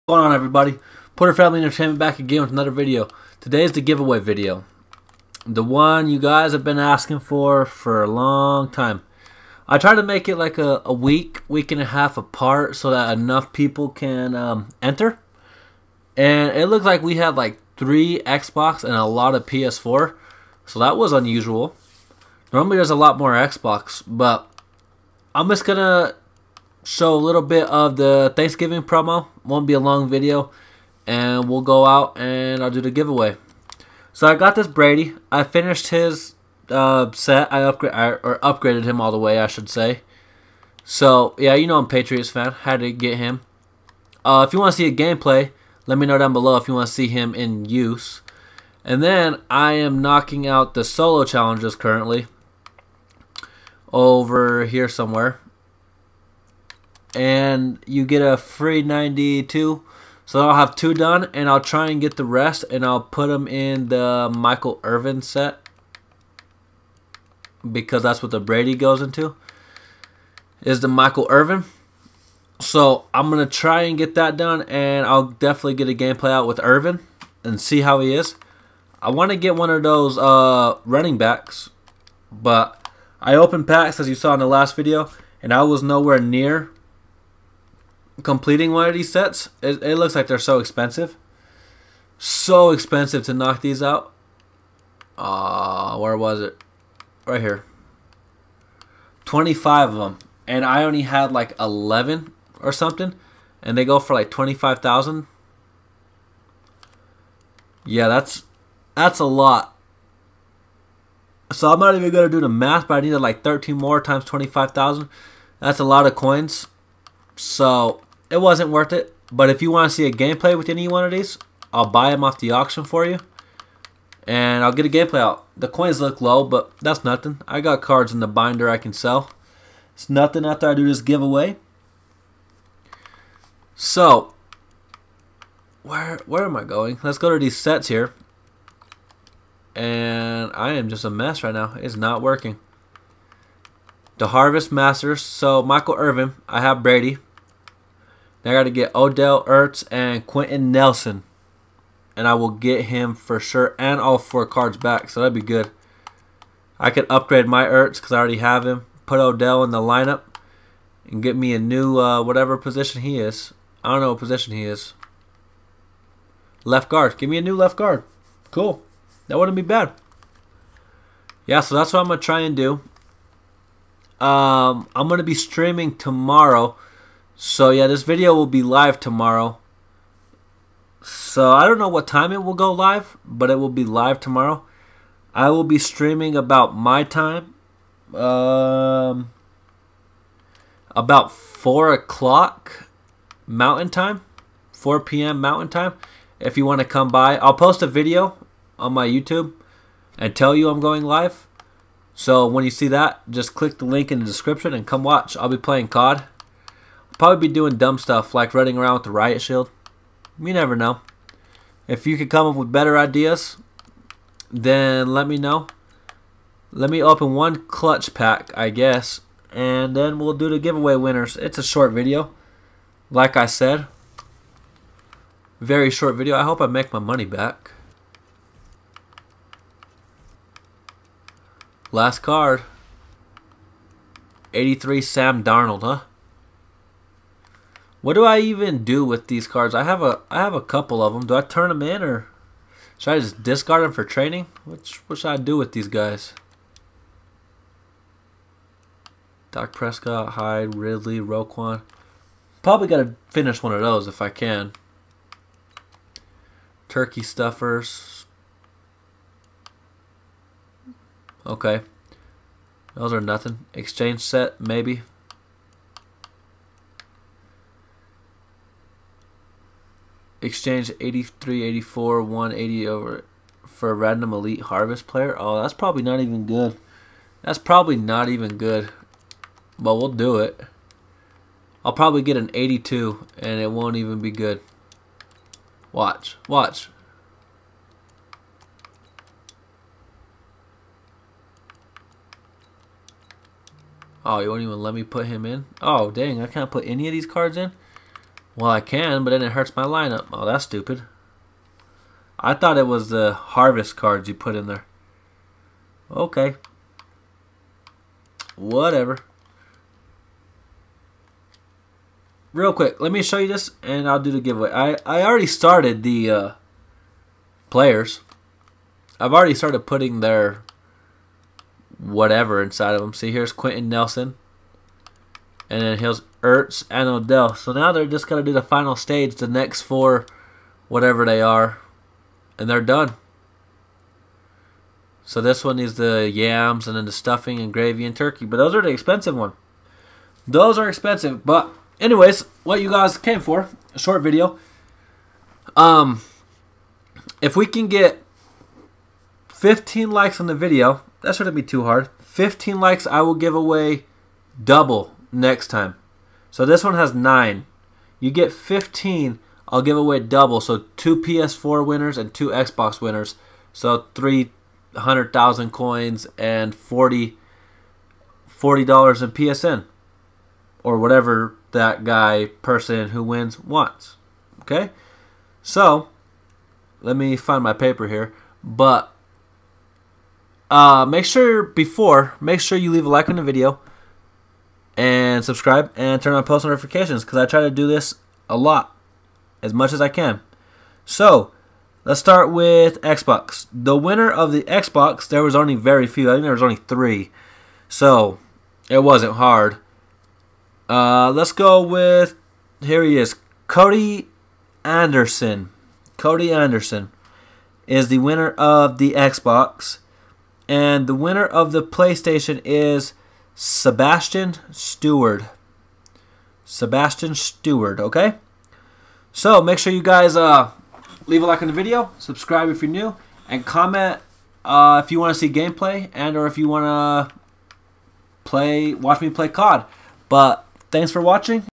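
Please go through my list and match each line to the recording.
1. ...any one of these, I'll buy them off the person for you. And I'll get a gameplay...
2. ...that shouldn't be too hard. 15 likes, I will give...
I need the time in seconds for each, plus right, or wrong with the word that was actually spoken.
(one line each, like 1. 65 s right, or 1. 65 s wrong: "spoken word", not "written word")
1. 120 s wrong: "auction", not "person"
2. 351 s right.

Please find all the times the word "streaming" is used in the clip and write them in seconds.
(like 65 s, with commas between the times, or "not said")
175 s, 185 s.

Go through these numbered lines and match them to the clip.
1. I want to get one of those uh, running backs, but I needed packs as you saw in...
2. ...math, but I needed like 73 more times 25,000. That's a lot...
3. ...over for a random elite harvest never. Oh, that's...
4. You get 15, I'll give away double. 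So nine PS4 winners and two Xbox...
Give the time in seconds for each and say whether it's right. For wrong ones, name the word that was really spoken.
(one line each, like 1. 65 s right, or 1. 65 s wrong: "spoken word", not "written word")
1. 79 s wrong: "opened", not "needed"
2. 112 s wrong: "13", not "73"
3. 272 s wrong: "player", not "never"
4. 358 s wrong: "two", not "nine".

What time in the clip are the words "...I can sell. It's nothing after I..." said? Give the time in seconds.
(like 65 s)
128 s.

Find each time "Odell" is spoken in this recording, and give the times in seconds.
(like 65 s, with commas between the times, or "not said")
148 s, 159 s, 327 s.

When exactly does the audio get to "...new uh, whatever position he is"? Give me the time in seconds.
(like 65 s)
161 s.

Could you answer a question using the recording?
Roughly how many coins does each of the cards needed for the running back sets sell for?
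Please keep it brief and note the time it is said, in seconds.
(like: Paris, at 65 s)
25,000, at 103 s.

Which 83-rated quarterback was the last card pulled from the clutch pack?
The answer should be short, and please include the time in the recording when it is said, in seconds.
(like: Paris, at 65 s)
Sam Darnold, at 234 s.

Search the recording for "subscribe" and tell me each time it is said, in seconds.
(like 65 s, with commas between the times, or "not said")
385 s, 422 s.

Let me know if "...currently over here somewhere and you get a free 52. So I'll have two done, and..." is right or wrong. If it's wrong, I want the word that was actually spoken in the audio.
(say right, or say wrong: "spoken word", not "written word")
wrong: "92", not "52".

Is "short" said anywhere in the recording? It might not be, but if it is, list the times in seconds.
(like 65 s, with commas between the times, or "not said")
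221 s, 225 s, 343 s.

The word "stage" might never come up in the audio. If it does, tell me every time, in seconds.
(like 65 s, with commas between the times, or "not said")
328 s.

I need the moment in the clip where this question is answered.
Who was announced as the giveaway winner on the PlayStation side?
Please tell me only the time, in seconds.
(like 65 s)
411 s.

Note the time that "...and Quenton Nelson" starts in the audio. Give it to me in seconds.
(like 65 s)
149 s.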